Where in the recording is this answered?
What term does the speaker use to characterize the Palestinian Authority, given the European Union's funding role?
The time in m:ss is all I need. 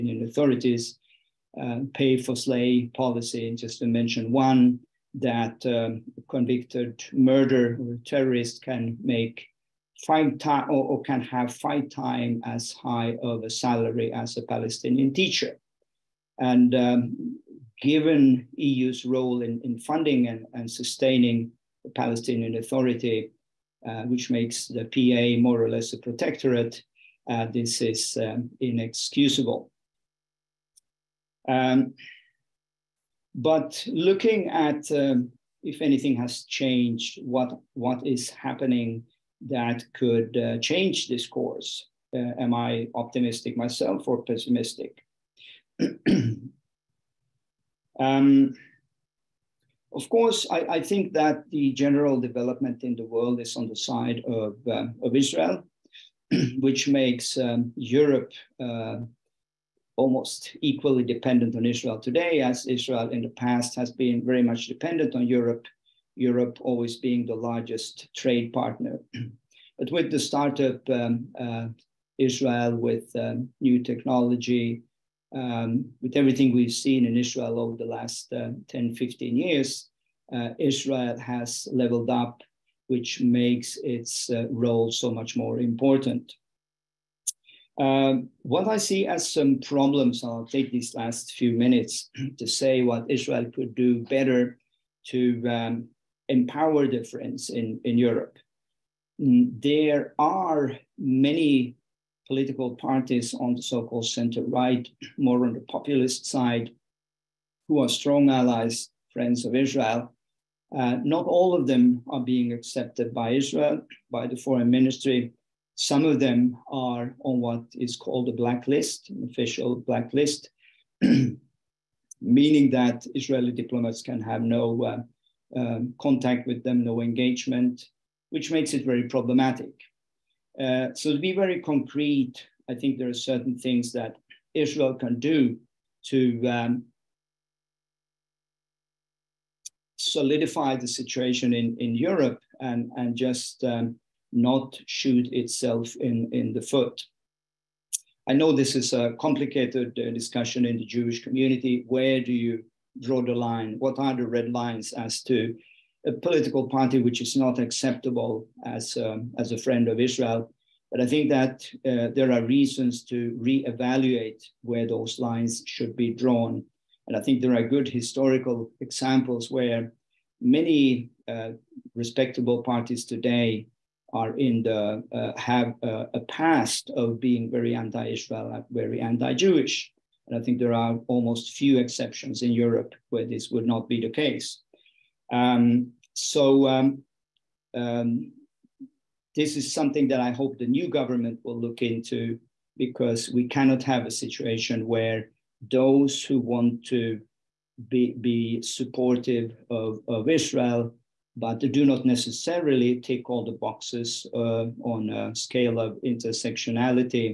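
0:25.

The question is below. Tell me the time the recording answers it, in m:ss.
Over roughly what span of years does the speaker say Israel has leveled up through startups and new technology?
1:18.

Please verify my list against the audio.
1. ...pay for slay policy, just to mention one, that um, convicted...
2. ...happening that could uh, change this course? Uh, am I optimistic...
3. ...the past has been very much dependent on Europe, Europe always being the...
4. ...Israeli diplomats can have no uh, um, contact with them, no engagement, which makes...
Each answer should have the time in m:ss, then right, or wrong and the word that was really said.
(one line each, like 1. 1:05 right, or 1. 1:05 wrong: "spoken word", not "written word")
1. 0:01 right
2. 0:38 right
3. 1:03 right
4. 2:03 right.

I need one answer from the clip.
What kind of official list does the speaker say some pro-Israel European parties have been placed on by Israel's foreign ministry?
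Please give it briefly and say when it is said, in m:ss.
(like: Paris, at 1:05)
a blacklist, at 1:59.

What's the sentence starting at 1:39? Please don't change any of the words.
There are many political parties on the so-called center-right, more on the populist side, who are strong allies, friends of Israel.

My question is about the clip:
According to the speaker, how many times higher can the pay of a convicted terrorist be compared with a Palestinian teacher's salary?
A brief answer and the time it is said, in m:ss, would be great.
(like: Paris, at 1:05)
5 times, at 0:11.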